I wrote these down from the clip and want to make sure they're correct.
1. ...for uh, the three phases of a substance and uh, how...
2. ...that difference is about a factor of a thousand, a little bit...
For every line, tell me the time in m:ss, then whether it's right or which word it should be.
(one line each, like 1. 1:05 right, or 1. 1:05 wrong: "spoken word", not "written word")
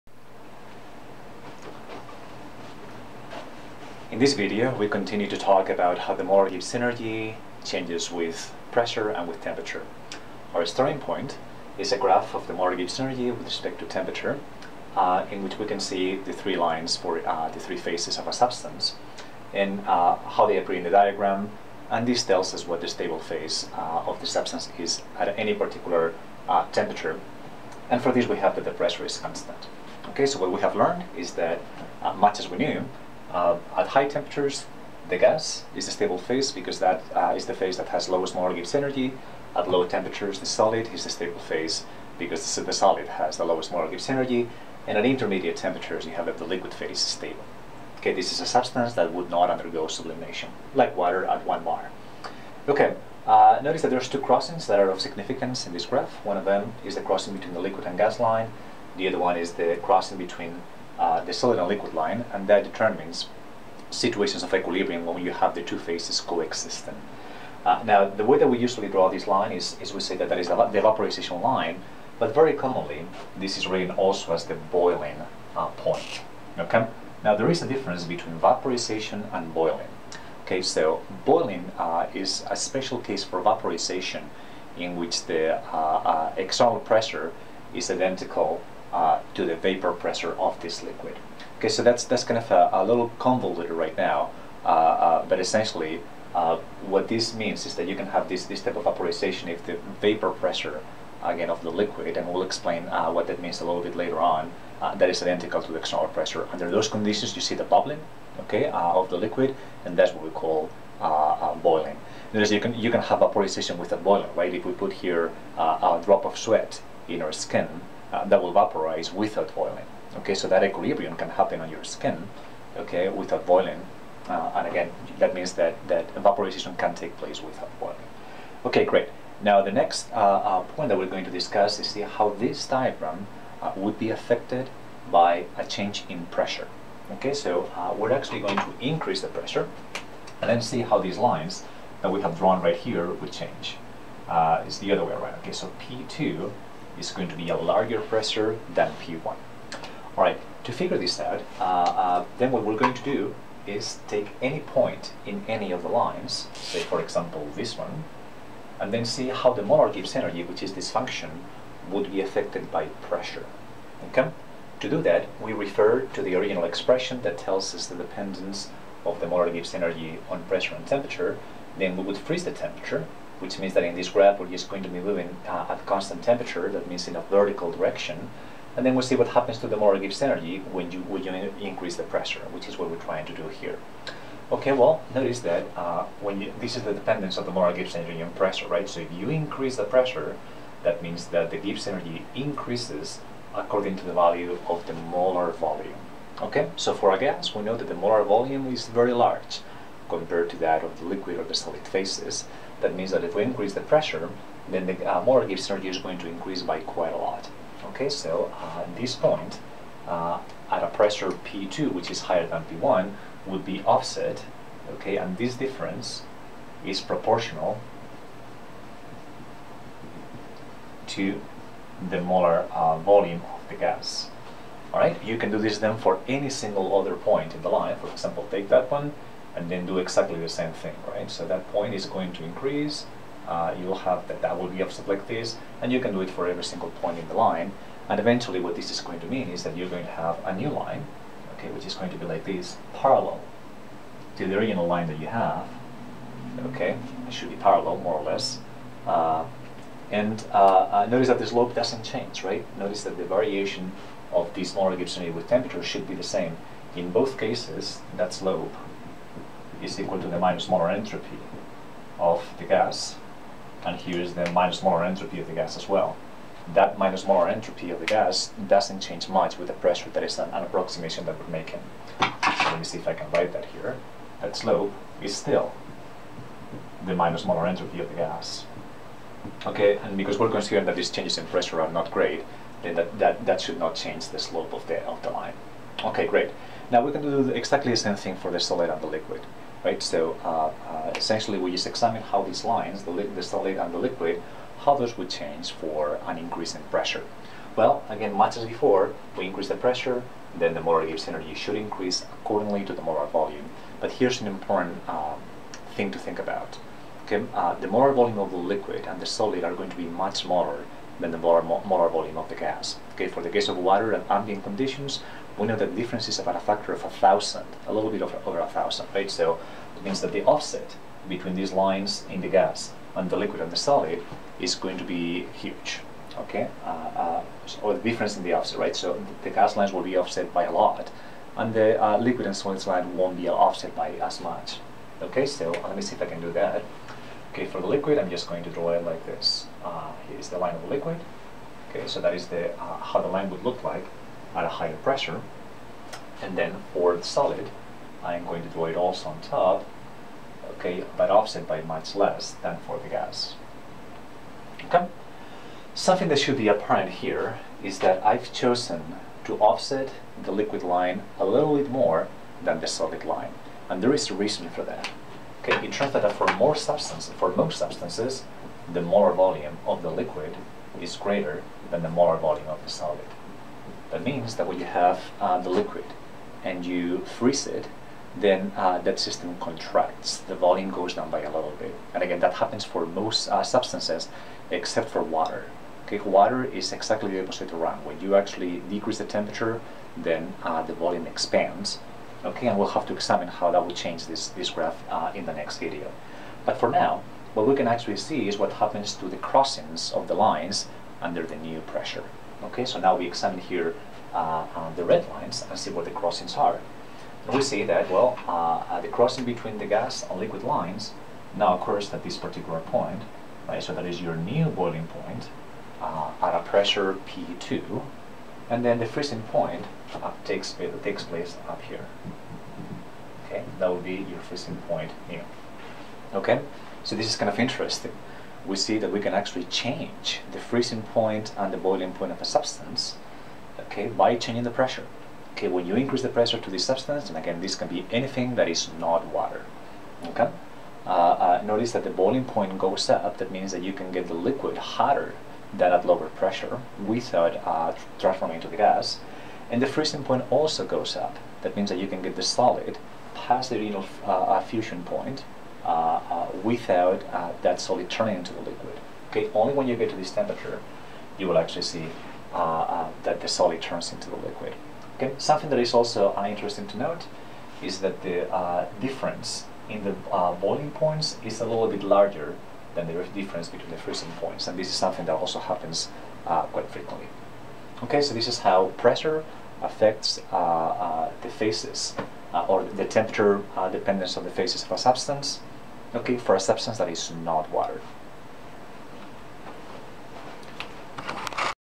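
1. 0:16 right
2. 5:15 right.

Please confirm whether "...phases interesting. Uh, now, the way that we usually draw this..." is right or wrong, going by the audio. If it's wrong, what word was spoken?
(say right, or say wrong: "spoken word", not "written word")
wrong: "coexisting", not "interesting".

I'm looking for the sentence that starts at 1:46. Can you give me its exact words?
Under those conditions, you see the bubbling, okay, of the liquid, and that's what we call boiling.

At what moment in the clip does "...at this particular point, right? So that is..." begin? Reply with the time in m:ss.
6:52.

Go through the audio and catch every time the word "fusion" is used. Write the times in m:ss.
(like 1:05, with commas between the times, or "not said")
7:34.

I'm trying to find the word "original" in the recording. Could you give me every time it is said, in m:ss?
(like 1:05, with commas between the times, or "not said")
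2:46, 4:04.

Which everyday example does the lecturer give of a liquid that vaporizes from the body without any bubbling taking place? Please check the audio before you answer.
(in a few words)
A drop of sweat.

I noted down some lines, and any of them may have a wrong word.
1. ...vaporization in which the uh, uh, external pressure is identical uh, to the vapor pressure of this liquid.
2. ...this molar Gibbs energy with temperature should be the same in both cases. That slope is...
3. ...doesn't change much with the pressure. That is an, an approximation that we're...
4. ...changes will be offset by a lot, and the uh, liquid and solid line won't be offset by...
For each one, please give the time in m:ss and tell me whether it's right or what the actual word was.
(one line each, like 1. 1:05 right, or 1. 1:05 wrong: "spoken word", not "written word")
1. 1:23 right
2. 4:14 right
3. 4:28 right
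4. 5:29 wrong: "lines", not "changes".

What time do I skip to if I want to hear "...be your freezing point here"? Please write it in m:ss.
7:04.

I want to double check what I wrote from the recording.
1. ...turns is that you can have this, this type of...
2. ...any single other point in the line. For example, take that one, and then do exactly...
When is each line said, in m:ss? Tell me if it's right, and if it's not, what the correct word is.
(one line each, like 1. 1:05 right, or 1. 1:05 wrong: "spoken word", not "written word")
1. 1:37 wrong: "means", not "turns"
2. 3:46 right.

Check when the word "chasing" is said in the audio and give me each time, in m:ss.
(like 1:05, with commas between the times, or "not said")
not said.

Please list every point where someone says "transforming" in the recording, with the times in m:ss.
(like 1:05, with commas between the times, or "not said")
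7:28.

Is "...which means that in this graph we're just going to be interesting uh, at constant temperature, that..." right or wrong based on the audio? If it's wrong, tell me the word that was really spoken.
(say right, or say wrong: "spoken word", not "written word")
wrong: "moving", not "interesting".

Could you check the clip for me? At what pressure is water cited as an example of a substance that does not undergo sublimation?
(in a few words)
1 bar.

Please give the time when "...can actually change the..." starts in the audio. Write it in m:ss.
7:09.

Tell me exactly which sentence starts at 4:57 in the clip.
Well, again, much as before, we increase the pressure, then the molar Gibbs energy should increase accordingly to the molar volume.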